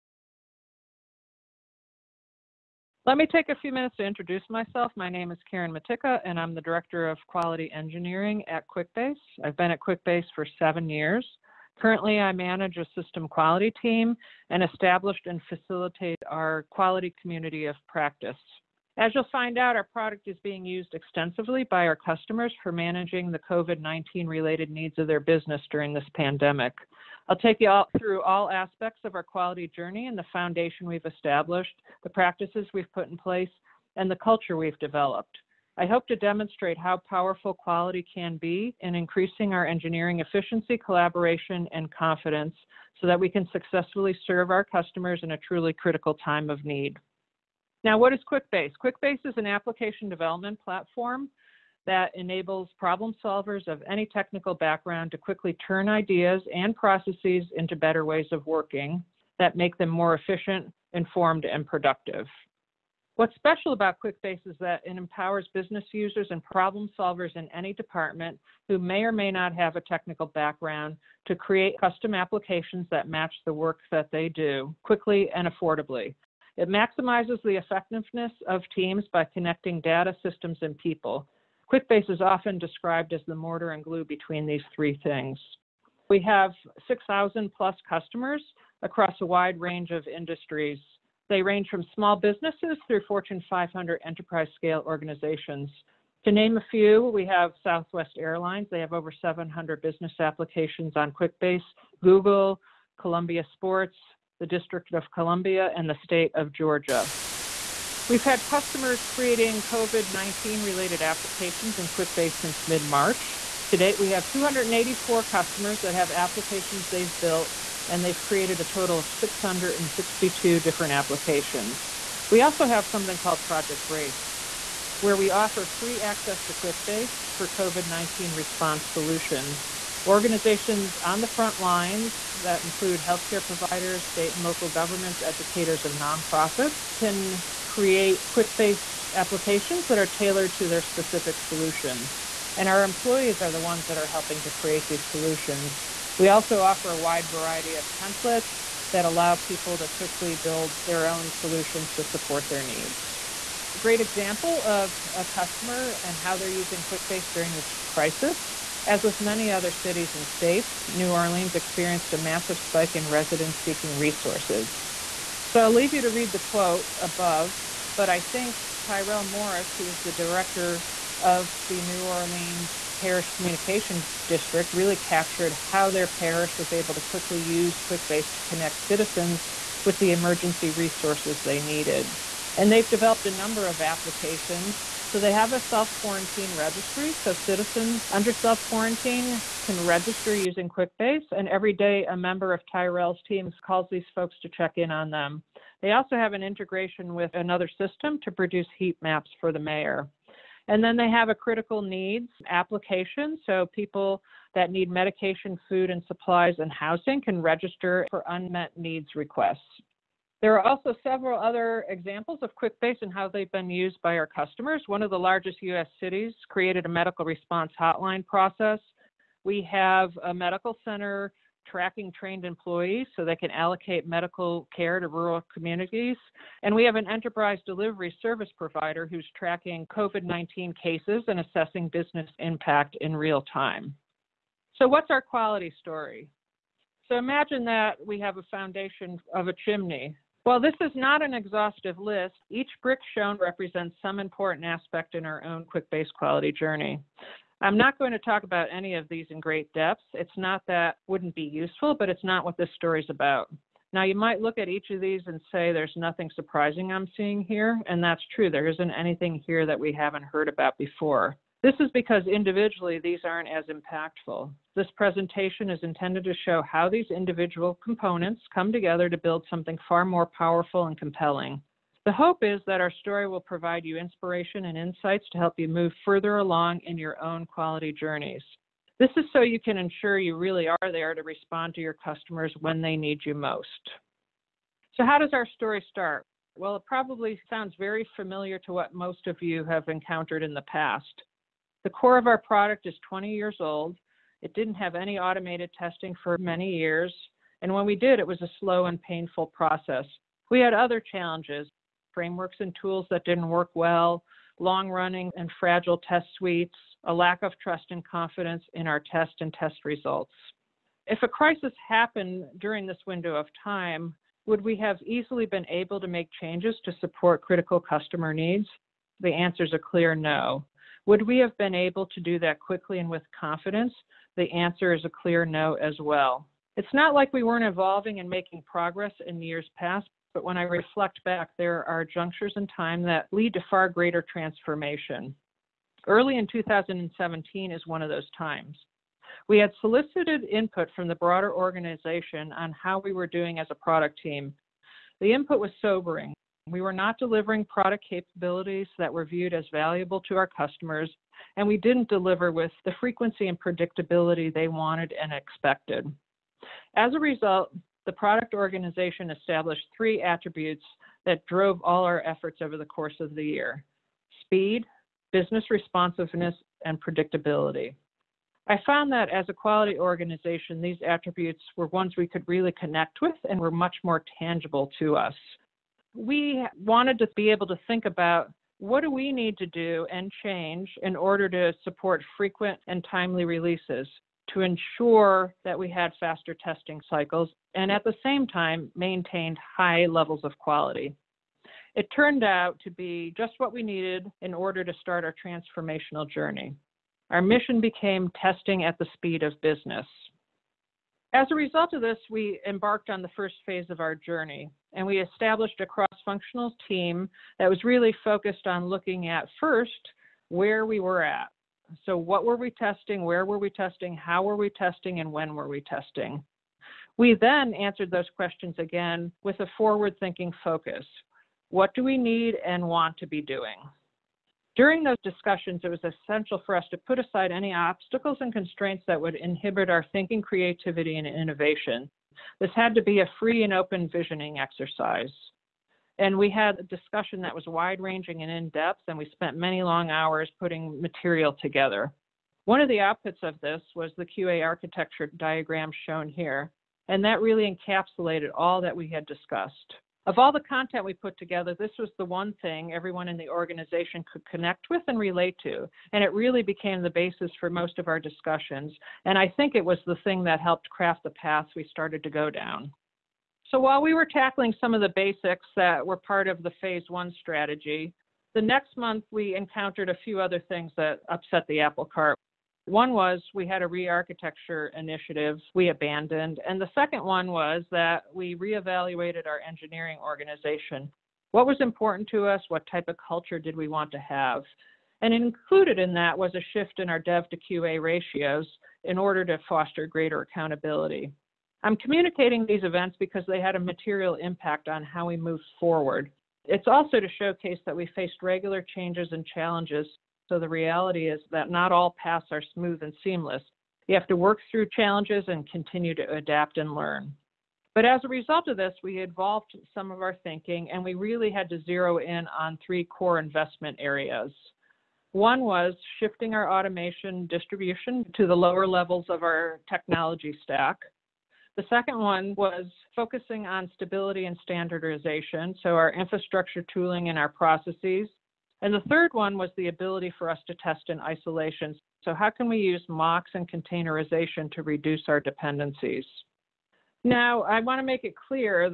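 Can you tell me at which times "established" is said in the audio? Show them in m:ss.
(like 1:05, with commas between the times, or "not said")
0:14, 0:31, 5:59, 6:45.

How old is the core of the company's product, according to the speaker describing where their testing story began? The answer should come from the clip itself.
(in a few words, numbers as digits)
20 years.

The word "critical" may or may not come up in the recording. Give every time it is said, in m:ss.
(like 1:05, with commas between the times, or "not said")
0:45, 3:21, 5:17.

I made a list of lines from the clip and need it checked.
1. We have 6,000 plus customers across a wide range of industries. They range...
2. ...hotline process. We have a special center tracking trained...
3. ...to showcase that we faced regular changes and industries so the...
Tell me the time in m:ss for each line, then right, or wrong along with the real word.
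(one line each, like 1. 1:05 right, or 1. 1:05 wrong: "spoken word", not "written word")
1. 1:26 right
2. 3:37 wrong: "medical", not "special"
3. 8:17 wrong: "challenges", not "industries".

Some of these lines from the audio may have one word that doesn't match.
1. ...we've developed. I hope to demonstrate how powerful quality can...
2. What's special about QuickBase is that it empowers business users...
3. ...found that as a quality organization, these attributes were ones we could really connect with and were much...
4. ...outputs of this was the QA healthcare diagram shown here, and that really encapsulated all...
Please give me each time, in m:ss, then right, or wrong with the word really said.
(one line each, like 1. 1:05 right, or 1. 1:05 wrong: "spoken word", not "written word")
1. 0:34 right
2. 1:03 right
3. 6:08 right
4. 7:22 wrong: "architecture", not "healthcare".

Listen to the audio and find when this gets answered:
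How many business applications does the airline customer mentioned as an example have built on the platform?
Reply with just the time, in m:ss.
1:38.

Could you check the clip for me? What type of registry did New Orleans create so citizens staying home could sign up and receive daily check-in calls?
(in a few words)
Self quarantine registry.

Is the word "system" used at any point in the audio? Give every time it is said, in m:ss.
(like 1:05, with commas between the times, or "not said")
0:12, 1:20, 3:17.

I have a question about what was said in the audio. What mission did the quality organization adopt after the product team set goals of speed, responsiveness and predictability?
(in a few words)
Testing at the speed of business.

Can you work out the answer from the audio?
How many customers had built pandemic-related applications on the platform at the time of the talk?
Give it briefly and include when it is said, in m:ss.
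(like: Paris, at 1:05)
284, at 1:54.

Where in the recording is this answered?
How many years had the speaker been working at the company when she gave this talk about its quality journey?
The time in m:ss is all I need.
0:10.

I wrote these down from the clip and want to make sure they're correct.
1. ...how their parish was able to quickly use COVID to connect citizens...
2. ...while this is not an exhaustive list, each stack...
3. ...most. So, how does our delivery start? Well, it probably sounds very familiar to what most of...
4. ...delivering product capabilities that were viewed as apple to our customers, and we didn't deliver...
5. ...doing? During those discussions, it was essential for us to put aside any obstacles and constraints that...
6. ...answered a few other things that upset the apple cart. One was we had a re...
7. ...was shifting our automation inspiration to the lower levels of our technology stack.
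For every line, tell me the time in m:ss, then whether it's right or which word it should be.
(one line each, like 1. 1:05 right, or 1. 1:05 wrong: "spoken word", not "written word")
1. 2:55 wrong: "QuickBase", not "COVID"
2. 4:00 wrong: "brick", not "stack"
3. 4:43 wrong: "story", not "delivery"
4. 5:47 wrong: "valuable", not "apple"
5. 7:03 right
6. 7:49 wrong: "encountered", not "answered"
7. 8:35 wrong: "distribution", not "inspiration".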